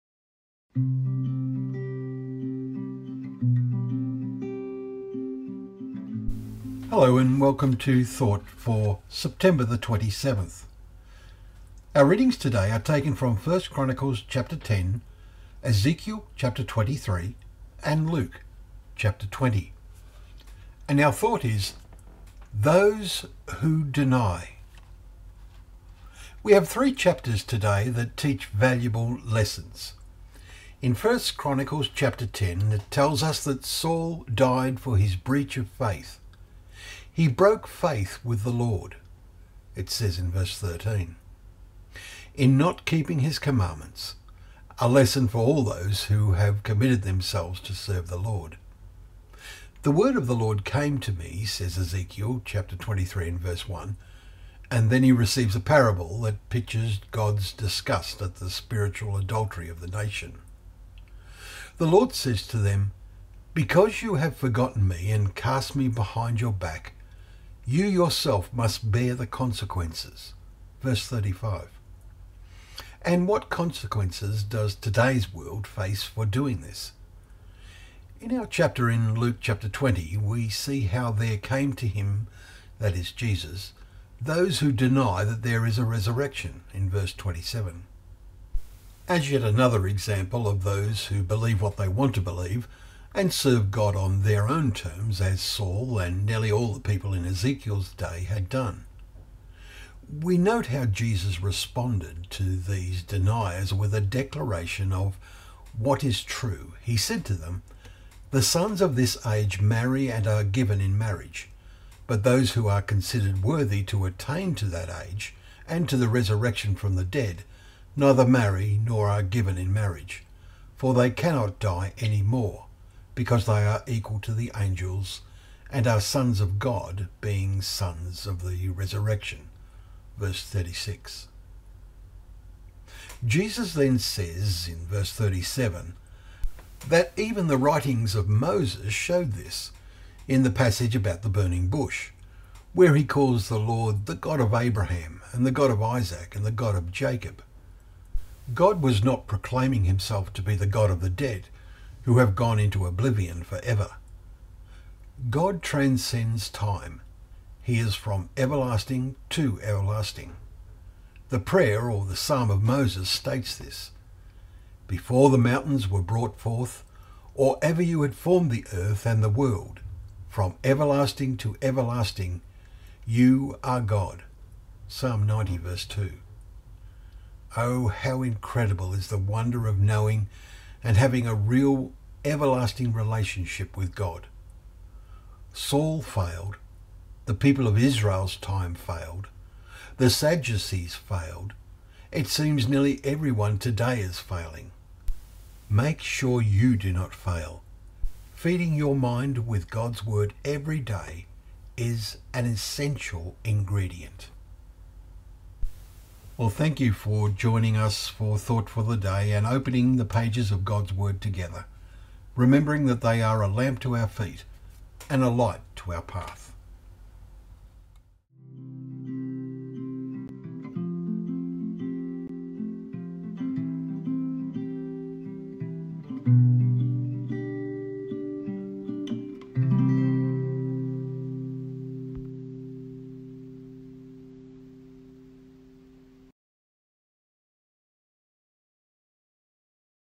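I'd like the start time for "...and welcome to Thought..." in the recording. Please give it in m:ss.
0:07.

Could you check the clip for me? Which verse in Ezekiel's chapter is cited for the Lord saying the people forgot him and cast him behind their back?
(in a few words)
Verse 35.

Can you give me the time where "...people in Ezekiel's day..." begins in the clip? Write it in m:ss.
1:36.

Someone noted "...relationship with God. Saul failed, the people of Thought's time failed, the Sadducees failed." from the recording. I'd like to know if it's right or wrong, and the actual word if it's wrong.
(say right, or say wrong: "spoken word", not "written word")
wrong: "Israel", not "Thought".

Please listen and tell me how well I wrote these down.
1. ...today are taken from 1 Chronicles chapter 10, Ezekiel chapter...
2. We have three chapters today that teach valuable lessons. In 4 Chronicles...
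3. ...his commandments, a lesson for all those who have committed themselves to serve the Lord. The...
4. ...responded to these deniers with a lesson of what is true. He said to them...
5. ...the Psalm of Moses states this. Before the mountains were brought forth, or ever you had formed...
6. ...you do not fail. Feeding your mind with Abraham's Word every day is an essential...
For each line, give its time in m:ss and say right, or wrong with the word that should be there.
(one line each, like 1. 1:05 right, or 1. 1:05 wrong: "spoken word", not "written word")
1. 0:12 right
2. 0:26 wrong: "1", not "4"
3. 0:43 right
4. 1:41 wrong: "declaration", not "lesson"
5. 2:42 right
6. 3:16 wrong: "God", not "Abraham".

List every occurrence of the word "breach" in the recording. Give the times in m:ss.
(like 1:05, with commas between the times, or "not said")
0:35.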